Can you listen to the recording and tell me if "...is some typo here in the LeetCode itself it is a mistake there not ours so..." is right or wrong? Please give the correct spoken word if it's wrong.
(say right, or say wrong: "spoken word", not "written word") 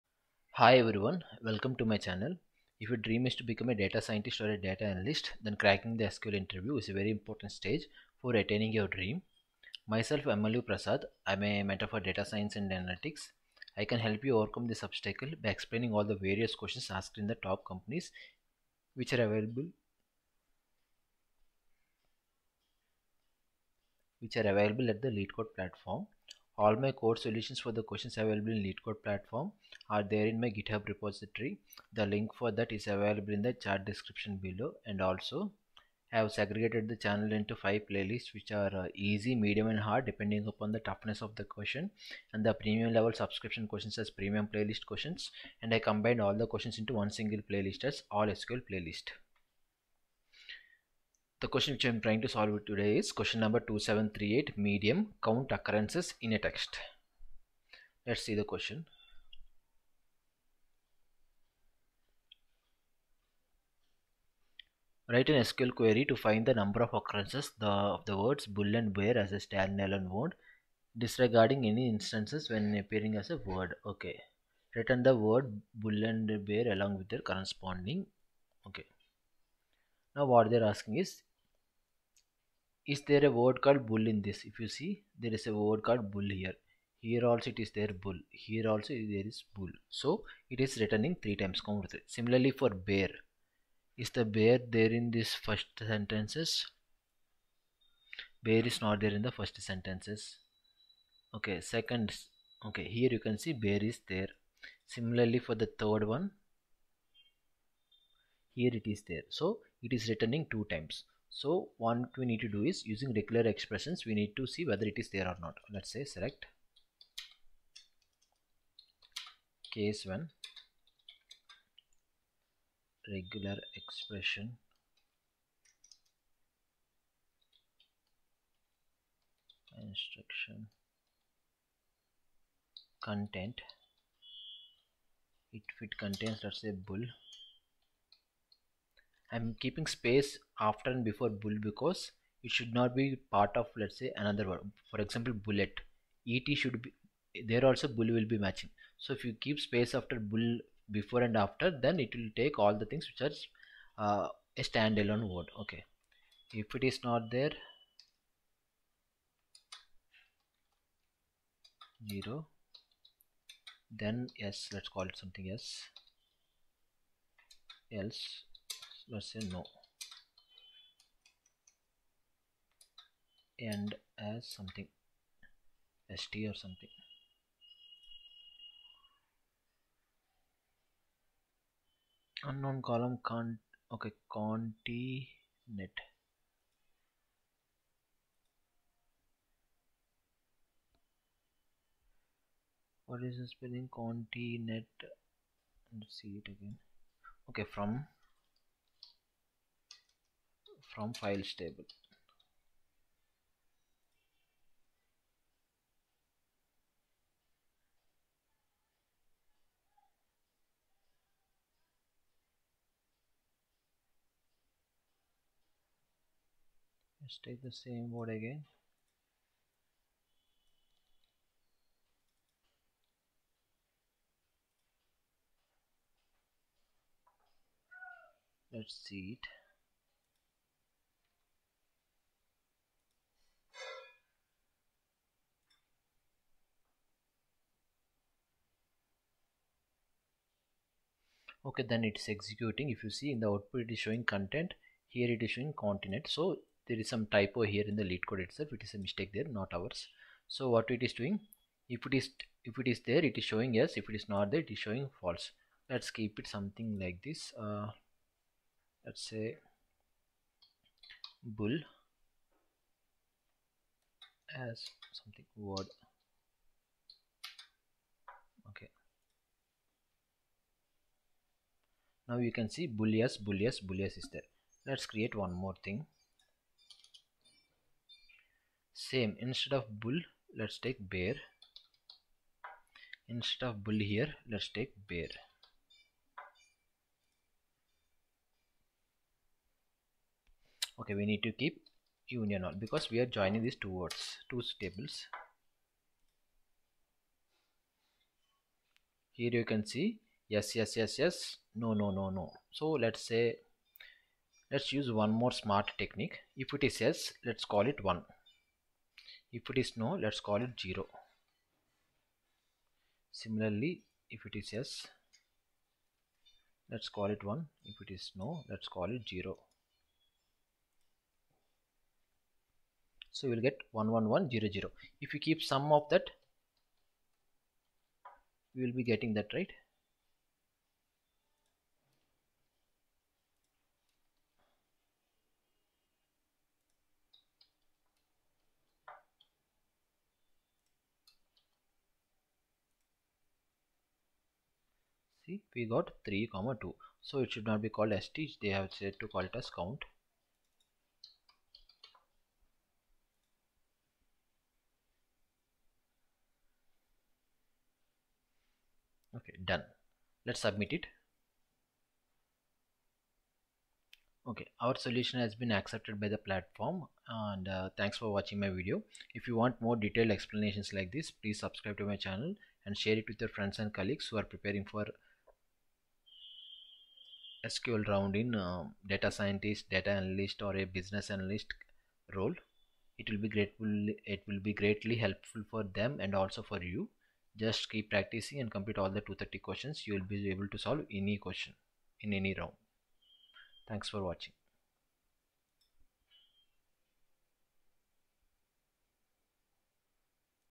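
right.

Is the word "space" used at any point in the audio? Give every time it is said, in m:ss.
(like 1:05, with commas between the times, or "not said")
2:19, 2:29.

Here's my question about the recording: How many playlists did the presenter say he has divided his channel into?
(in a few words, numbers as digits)
5.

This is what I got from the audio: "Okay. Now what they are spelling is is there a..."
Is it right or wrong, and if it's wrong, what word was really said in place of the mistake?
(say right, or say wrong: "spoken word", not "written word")
wrong: "asking", not "spelling".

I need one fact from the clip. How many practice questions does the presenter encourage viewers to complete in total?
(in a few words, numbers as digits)
230.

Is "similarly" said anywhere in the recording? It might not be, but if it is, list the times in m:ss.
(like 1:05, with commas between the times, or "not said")
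1:32, 1:44, 5:13.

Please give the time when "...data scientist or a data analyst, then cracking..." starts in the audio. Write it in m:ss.
0:03.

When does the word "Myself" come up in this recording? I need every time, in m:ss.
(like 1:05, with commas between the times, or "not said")
0:09.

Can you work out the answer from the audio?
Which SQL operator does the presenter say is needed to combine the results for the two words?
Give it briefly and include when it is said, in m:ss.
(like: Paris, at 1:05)
UNION ALL, at 4:52.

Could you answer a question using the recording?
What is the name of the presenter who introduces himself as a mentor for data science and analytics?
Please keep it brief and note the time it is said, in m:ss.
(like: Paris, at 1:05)
MLV Prasad, at 0:10.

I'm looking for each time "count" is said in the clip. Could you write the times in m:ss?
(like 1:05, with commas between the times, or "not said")
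0:55, 1:31, 5:49.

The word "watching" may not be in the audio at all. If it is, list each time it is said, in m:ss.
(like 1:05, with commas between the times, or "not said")
6:08, 6:34.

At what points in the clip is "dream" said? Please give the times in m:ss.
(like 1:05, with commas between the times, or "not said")
0:02, 0:08.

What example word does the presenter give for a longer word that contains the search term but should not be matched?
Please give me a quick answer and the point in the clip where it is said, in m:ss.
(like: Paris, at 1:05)
bullet, at 2:25.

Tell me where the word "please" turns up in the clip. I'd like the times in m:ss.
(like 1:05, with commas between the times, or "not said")
6:11.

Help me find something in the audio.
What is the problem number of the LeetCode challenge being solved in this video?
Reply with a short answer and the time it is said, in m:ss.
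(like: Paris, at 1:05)
2738, at 0:53.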